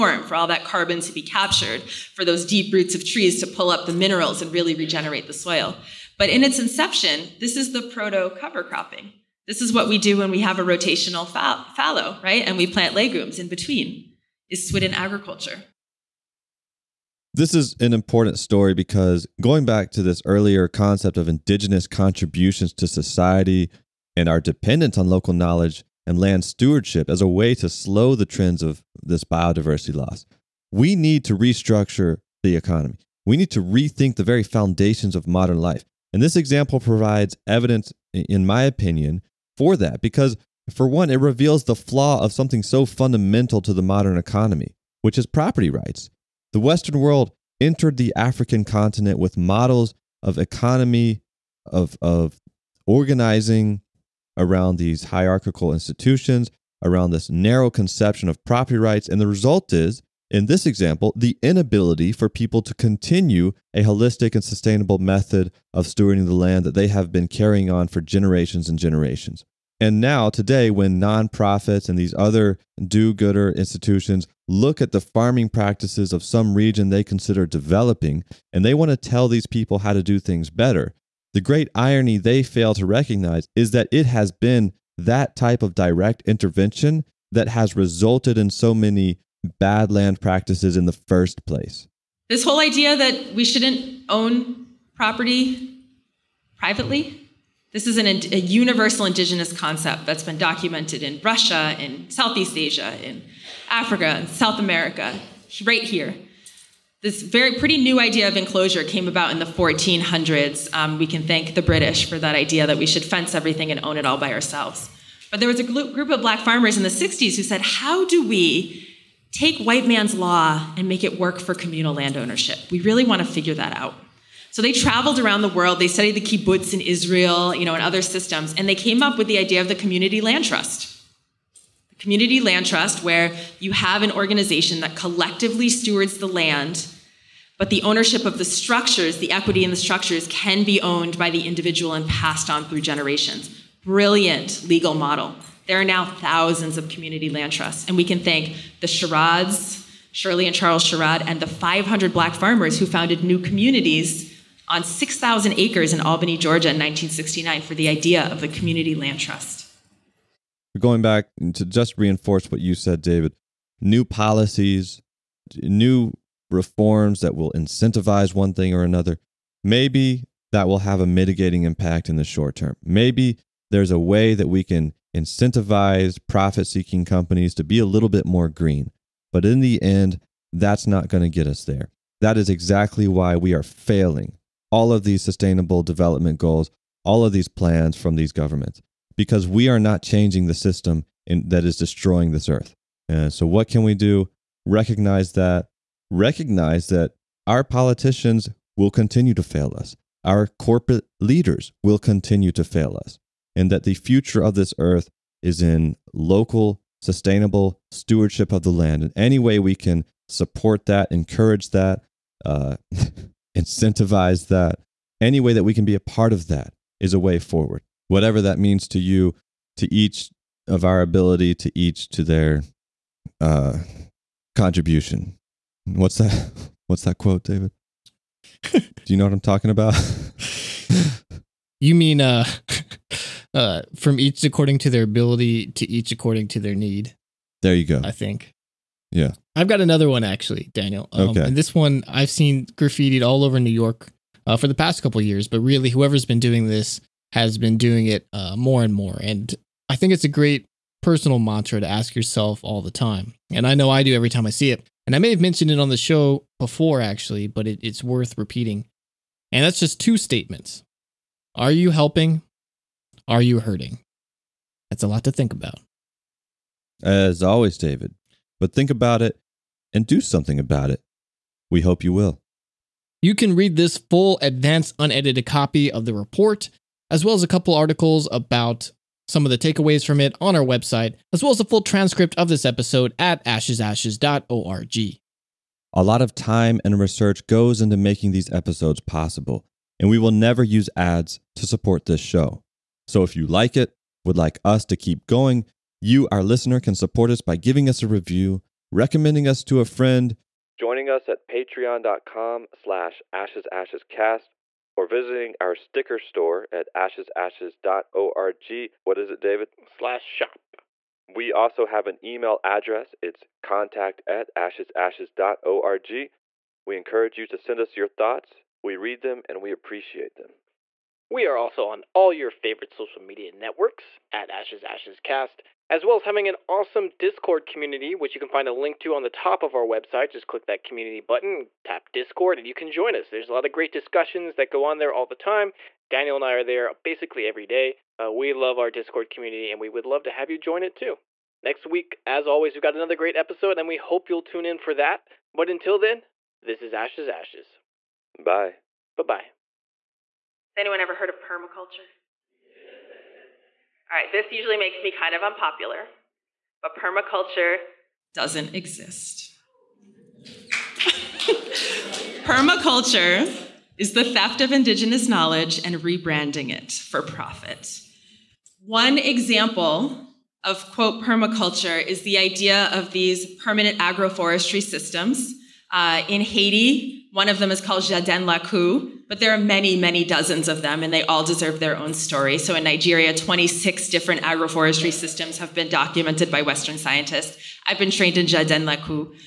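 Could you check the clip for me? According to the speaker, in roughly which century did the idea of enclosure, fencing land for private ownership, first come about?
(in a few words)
1400s.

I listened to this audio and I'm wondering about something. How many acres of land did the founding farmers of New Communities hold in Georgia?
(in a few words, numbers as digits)
6,000.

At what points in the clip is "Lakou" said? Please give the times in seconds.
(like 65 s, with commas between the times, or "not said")
378 s, 388 s.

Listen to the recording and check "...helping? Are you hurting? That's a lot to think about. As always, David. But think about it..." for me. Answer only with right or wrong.
right.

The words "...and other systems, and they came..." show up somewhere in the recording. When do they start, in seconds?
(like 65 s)
127 s.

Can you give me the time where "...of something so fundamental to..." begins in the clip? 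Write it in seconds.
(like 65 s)
42 s.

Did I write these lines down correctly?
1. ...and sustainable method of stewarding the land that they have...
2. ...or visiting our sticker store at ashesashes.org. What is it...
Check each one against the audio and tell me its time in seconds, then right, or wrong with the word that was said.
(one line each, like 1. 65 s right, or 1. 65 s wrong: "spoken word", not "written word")
1. 64 s right
2. 304 s right.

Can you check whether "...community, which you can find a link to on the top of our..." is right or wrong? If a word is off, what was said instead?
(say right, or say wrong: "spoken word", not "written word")
right.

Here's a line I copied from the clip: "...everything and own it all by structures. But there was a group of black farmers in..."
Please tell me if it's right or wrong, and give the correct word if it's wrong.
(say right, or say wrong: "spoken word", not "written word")
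wrong: "ourselves", not "structures".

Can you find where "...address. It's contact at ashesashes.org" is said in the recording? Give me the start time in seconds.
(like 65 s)
312 s.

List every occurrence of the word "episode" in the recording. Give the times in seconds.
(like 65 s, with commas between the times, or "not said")
282 s, 288 s, 343 s.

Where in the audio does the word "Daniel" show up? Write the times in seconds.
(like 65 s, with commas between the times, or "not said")
240 s, 336 s.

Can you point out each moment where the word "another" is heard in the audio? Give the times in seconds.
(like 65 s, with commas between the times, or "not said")
168 s, 239 s, 342 s.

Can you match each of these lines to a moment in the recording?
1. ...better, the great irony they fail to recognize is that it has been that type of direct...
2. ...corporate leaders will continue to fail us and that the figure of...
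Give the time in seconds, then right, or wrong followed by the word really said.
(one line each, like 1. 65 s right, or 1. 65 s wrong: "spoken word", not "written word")
1. 80 s right
2. 200 s wrong: "future", not "figure".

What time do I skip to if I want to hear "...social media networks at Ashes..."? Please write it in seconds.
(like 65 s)
322 s.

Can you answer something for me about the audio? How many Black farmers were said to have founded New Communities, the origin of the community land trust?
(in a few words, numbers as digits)
500.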